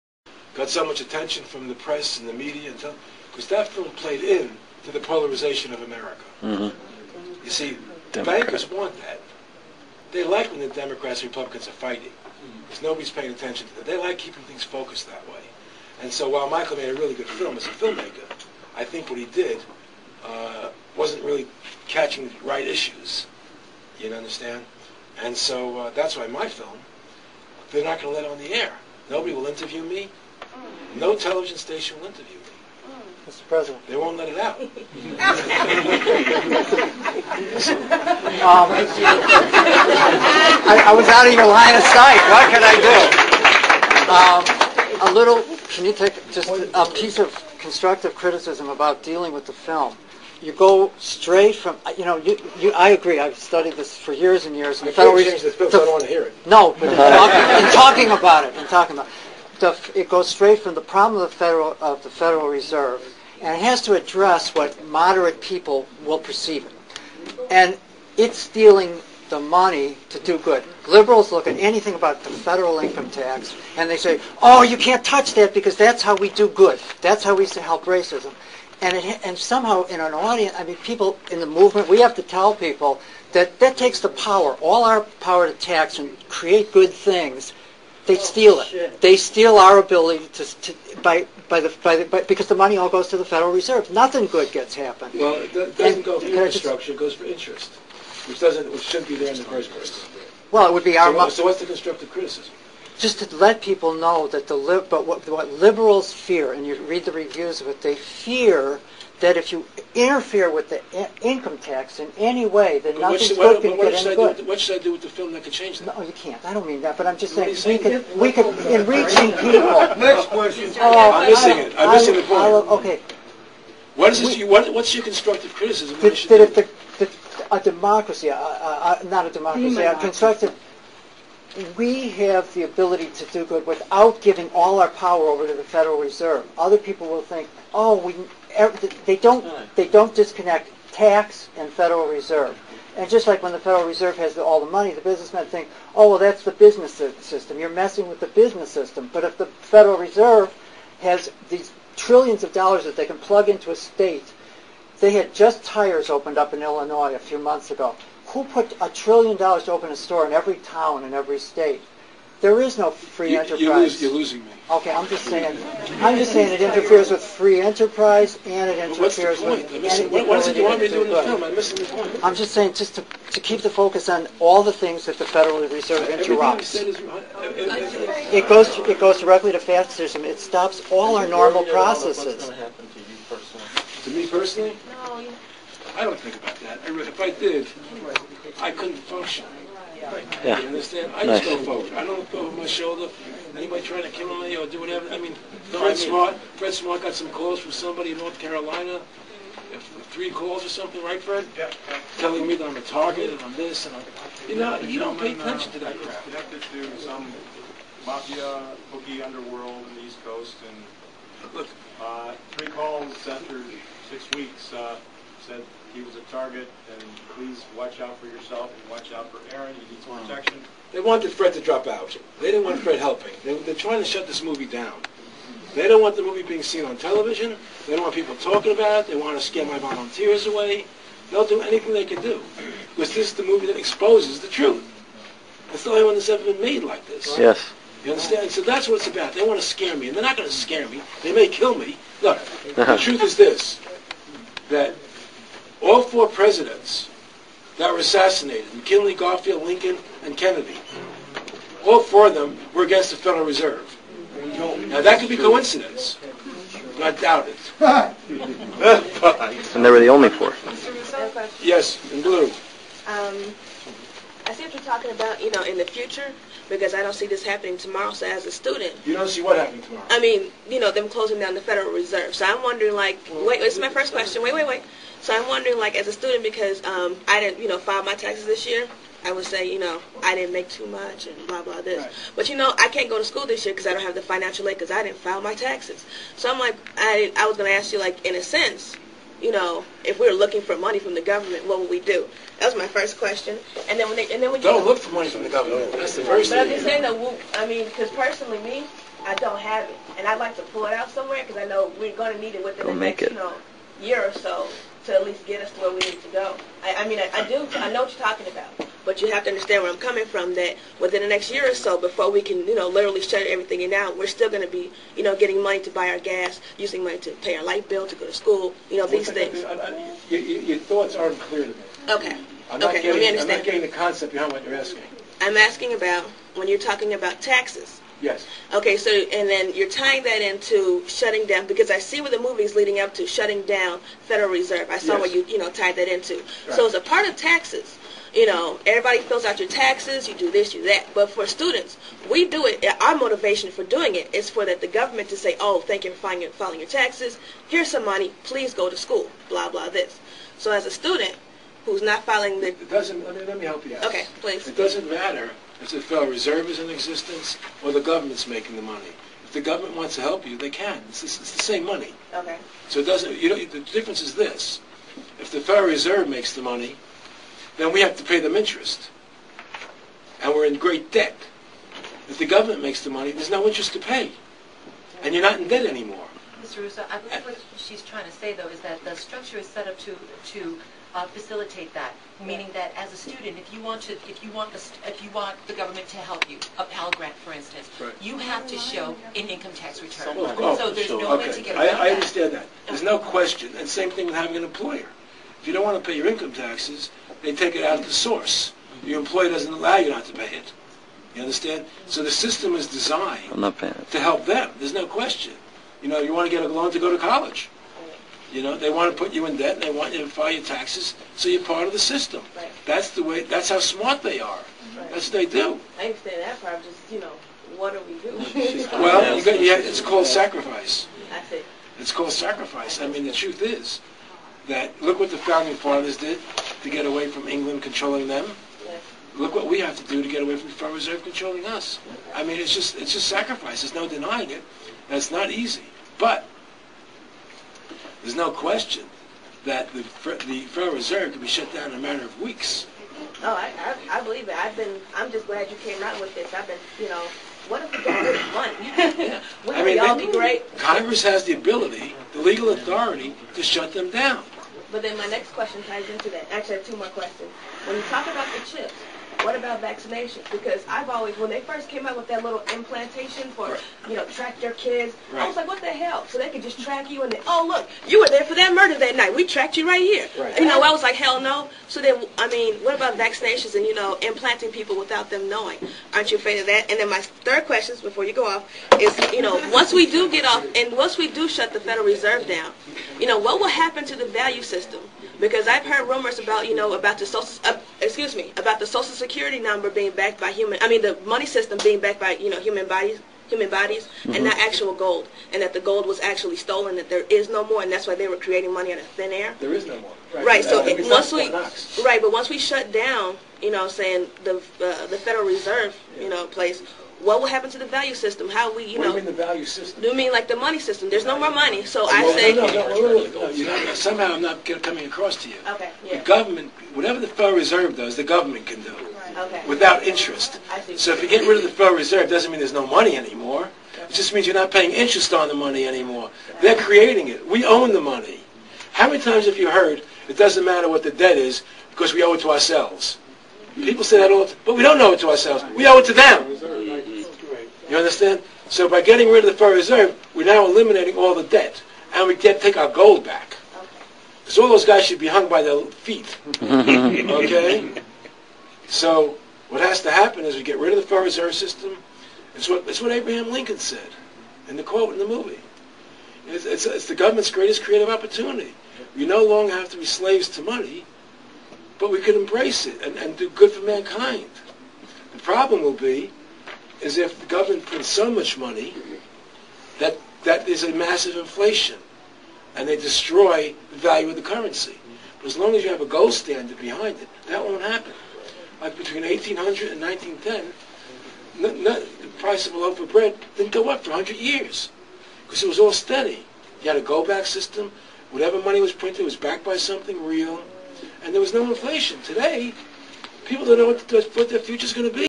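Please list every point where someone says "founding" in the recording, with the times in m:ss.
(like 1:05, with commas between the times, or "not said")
7:05.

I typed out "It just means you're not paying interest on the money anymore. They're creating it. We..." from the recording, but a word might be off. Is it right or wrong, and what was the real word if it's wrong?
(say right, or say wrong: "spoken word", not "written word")
right.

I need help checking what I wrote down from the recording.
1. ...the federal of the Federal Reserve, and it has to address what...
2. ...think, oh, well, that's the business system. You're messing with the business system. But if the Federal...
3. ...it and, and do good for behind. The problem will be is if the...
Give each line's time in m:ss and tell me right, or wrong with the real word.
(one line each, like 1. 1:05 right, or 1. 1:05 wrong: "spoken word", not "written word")
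1. 1:01 right
2. 2:25 right
3. 9:22 wrong: "mankind", not "behind".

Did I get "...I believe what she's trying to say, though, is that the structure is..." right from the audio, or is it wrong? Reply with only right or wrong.
right.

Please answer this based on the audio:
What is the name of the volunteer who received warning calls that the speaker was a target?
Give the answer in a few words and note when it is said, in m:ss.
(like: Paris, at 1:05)
Fred Smart, at 3:16.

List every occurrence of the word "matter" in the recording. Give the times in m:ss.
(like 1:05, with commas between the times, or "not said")
5:55, 7:21, 8:50.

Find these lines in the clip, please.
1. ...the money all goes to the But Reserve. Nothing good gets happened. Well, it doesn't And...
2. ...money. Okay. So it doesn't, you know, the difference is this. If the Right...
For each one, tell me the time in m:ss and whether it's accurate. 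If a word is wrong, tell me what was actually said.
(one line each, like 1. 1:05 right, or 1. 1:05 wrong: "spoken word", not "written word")
1. 1:32 wrong: "Federal", not "But"
2. 6:01 wrong: "Federal", not "Right".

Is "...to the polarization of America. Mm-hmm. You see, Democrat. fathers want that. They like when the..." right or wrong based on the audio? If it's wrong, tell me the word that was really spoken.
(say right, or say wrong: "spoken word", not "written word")
wrong: "bankers", not "fathers".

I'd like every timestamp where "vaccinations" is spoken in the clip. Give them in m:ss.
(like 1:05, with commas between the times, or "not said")
7:39, 7:53.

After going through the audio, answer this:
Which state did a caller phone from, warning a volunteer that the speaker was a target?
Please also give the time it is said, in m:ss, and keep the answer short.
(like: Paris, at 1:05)
North Carolina, at 3:18.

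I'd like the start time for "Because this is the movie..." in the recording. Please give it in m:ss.
3:52.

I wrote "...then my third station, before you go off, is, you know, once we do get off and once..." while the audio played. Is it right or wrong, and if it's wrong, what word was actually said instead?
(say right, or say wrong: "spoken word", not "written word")
wrong: "question", not "station".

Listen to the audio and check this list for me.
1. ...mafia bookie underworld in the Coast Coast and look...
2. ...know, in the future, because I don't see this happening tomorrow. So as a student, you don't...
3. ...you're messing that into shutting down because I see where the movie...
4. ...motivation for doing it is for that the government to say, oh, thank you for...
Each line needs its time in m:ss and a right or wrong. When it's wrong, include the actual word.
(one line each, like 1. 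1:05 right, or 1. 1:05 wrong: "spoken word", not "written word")
1. 3:28 wrong: "East", not "Coast"
2. 4:25 right
3. 5:29 wrong: "tying", not "messing"
4. 5:43 right.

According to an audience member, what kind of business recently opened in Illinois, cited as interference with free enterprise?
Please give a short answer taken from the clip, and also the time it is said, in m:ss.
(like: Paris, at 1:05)
tires, at 2:35.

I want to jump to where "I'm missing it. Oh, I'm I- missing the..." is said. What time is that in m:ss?
2:00.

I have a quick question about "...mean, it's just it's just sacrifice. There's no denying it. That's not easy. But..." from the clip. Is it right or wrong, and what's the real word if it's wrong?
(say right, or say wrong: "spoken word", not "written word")
right.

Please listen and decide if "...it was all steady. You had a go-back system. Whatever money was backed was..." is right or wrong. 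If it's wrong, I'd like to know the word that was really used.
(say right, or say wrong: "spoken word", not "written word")
wrong: "printed", not "backed".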